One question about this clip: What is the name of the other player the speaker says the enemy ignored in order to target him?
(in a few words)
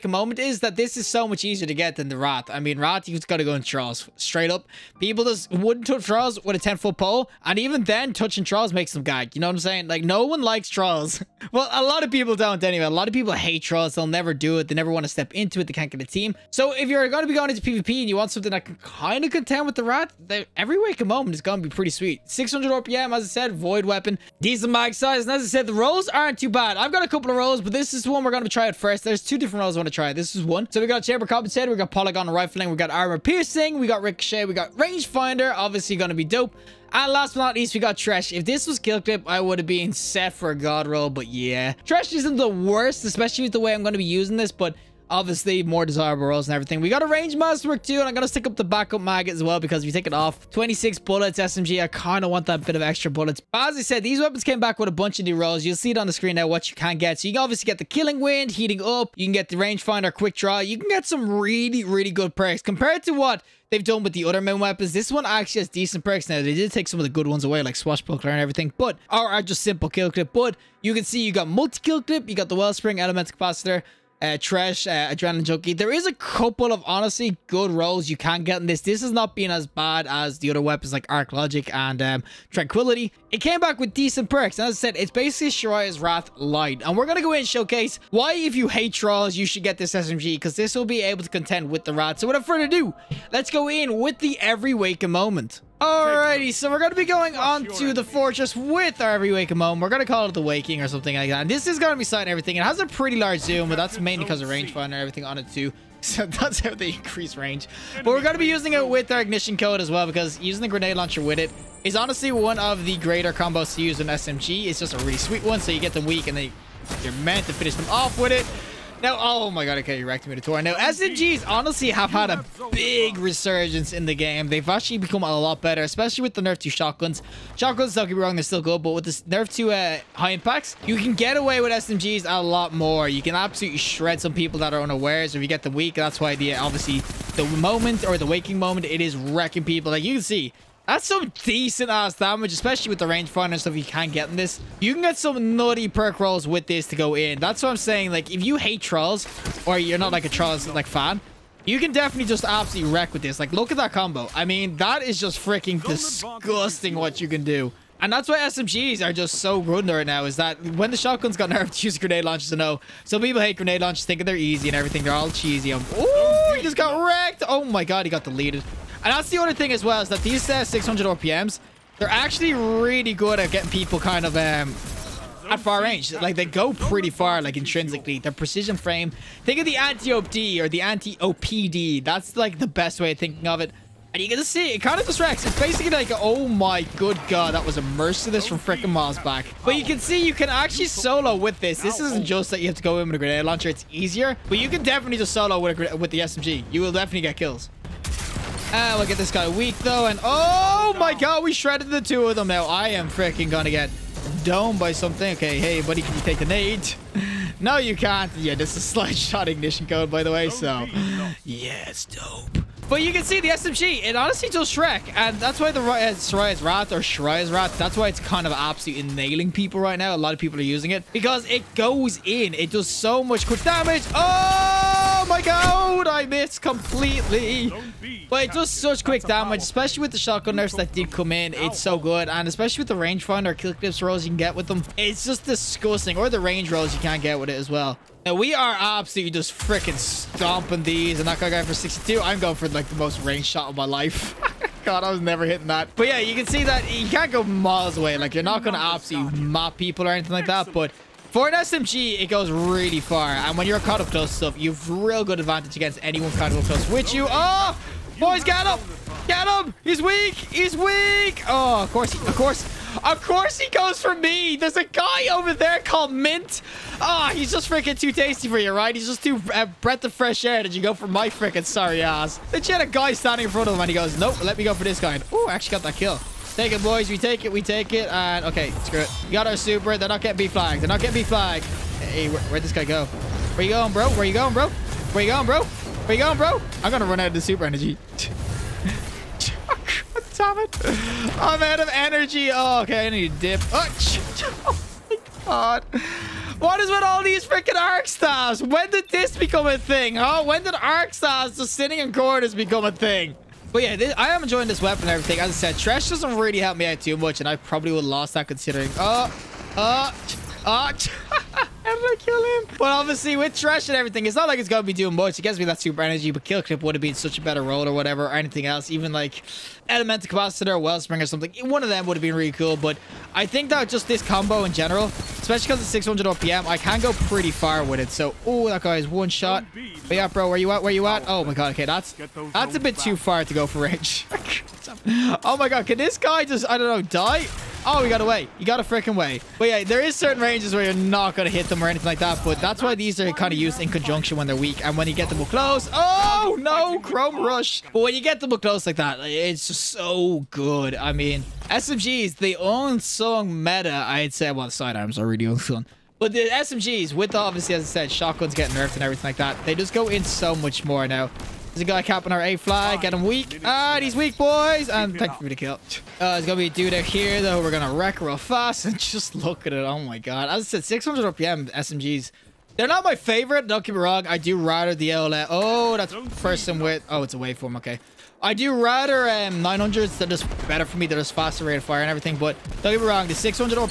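Mint.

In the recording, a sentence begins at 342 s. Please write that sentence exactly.
But that's why these are kind of used in conjunction when they're weak.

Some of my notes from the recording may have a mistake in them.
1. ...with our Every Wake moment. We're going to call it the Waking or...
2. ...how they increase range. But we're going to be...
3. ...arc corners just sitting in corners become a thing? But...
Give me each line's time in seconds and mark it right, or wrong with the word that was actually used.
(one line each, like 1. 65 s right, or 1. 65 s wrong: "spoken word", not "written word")
1. 98 s right
2. 106 s right
3. 300 s wrong: "stars", not "corners".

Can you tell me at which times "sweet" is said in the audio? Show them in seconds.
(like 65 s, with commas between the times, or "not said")
21 s, 115 s.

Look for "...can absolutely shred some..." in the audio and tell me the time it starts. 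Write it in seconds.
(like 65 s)
133 s.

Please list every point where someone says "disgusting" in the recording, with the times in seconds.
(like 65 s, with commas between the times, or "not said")
155 s, 235 s.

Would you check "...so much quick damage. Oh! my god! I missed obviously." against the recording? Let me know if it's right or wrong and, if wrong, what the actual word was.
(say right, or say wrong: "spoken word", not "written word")
wrong: "completely", not "obviously".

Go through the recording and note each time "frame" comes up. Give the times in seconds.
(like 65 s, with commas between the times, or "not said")
178 s.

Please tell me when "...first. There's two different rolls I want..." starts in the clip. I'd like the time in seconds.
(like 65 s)
28 s.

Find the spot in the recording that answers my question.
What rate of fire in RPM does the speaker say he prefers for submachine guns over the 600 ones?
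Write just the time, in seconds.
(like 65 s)
379 s.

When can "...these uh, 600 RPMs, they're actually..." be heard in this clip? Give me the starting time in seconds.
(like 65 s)
170 s.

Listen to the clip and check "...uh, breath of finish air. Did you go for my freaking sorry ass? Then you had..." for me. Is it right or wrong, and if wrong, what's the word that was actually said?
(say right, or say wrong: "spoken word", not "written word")
wrong: "fresh", not "finish".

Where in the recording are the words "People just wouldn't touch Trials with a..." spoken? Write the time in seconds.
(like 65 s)
4 s.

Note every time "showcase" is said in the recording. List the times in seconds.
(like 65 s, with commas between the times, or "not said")
87 s.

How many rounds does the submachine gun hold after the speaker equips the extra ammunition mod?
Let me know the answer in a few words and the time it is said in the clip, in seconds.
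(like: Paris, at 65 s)
26, at 50 s.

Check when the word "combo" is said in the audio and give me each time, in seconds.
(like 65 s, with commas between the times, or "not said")
113 s, 153 s, 324 s.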